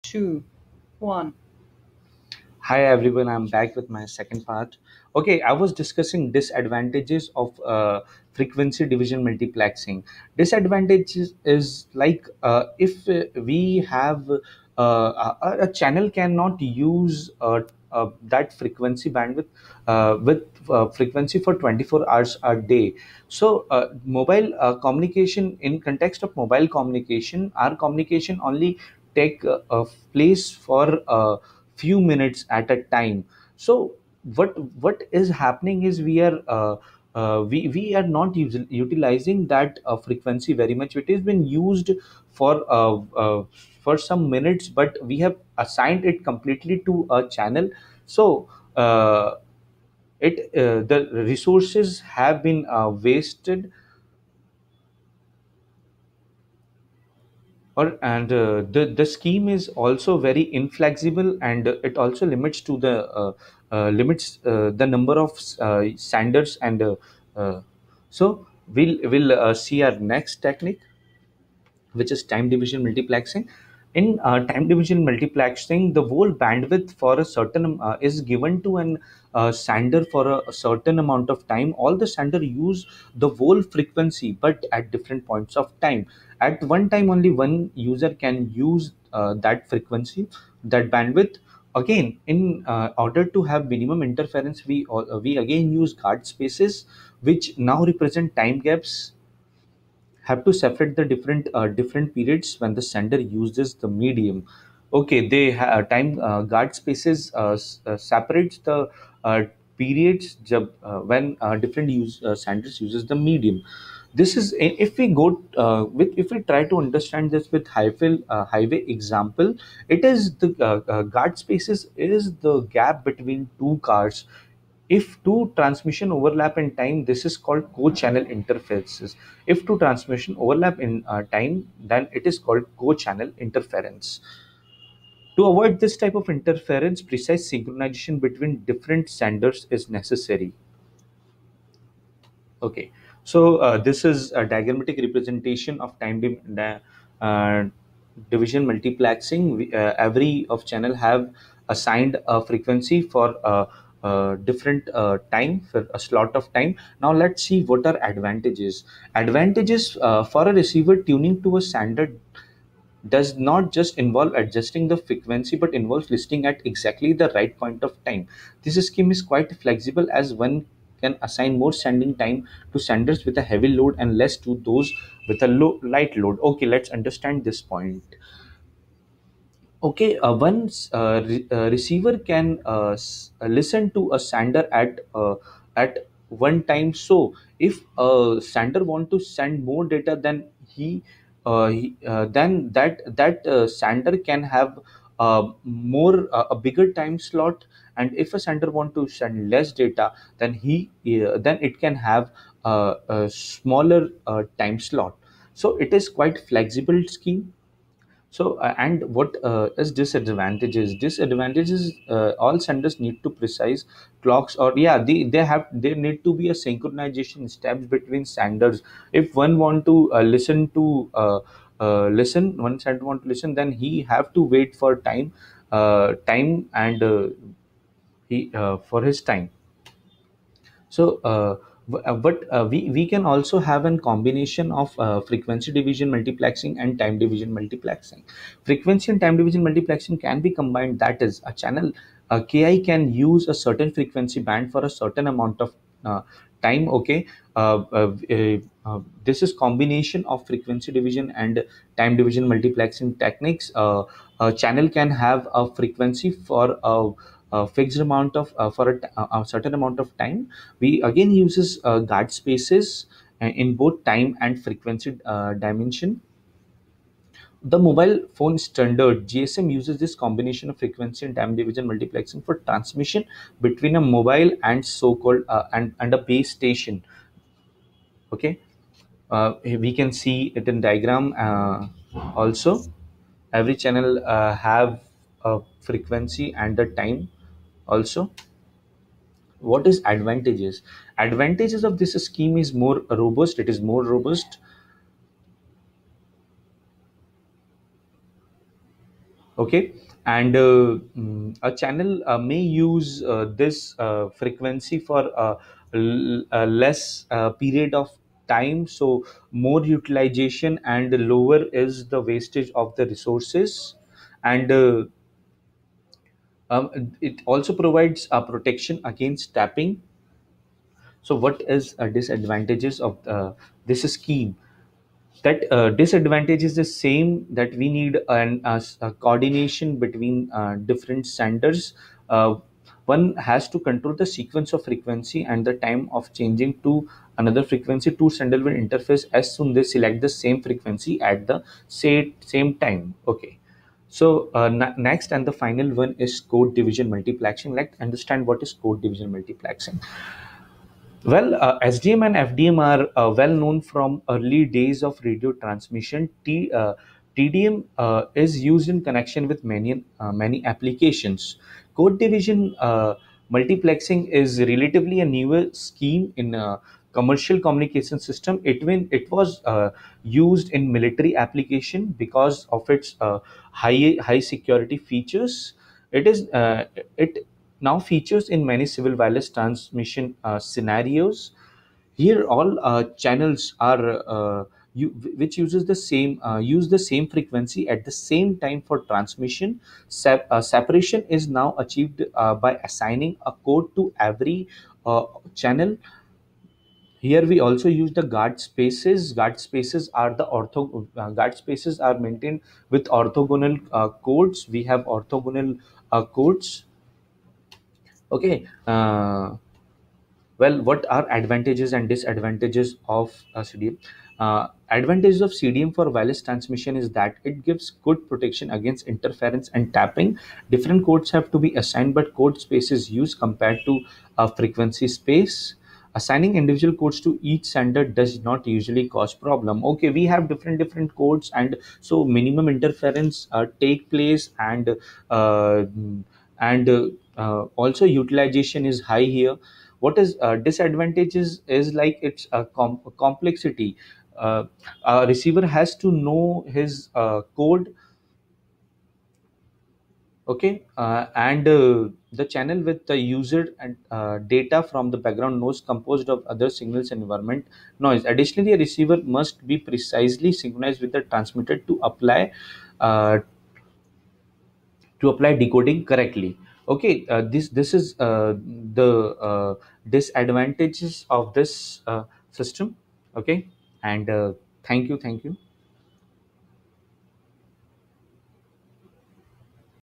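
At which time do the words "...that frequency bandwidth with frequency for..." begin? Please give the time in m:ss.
0:18.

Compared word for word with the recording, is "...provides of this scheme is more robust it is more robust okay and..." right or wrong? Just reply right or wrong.
wrong.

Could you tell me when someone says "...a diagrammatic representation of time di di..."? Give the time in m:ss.
2:24.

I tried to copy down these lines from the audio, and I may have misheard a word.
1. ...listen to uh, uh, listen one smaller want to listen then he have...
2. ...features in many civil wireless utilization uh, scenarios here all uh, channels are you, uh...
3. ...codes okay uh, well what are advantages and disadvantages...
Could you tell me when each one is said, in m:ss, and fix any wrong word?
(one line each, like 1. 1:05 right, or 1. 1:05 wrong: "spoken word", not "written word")
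1. 3:40 wrong: "sender", not "smaller"
2. 6:17 wrong: "transmission", not "utilization"
3. 6:46 right.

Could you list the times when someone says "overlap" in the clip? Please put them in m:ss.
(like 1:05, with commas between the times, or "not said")
2:06, 2:10.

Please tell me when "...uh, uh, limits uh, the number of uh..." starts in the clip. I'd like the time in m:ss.
1:03.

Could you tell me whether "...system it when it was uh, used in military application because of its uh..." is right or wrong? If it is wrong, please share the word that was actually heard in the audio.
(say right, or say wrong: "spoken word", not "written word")
right.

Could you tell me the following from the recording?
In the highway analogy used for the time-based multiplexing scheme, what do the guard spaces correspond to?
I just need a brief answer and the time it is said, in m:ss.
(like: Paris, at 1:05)
gap between two cars, at 2:02.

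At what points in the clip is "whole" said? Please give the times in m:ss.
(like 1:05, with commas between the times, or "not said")
1:16, 1:23.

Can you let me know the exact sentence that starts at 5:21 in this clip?
So what is a uh, disadvantages of uh, this scheme?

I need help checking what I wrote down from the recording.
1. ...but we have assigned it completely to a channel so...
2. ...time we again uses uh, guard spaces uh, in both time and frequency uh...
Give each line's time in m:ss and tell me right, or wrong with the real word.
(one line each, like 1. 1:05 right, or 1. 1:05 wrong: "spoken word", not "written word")
1. 0:44 right
2. 4:20 right.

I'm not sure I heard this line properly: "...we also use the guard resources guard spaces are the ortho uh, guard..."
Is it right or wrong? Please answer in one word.
wrong.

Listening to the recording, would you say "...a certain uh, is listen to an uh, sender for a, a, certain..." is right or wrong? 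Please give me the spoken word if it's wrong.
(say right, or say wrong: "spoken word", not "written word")
wrong: "given", not "listen".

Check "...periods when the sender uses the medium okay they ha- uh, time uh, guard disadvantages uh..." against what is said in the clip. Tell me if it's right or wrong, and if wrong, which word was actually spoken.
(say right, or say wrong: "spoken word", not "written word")
wrong: "spaces", not "disadvantages".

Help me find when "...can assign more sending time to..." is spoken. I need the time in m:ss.
2:51.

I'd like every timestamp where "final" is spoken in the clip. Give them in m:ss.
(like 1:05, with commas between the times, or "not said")
5:45.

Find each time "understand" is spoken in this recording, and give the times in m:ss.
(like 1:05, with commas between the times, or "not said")
1:56, 2:56, 5:48.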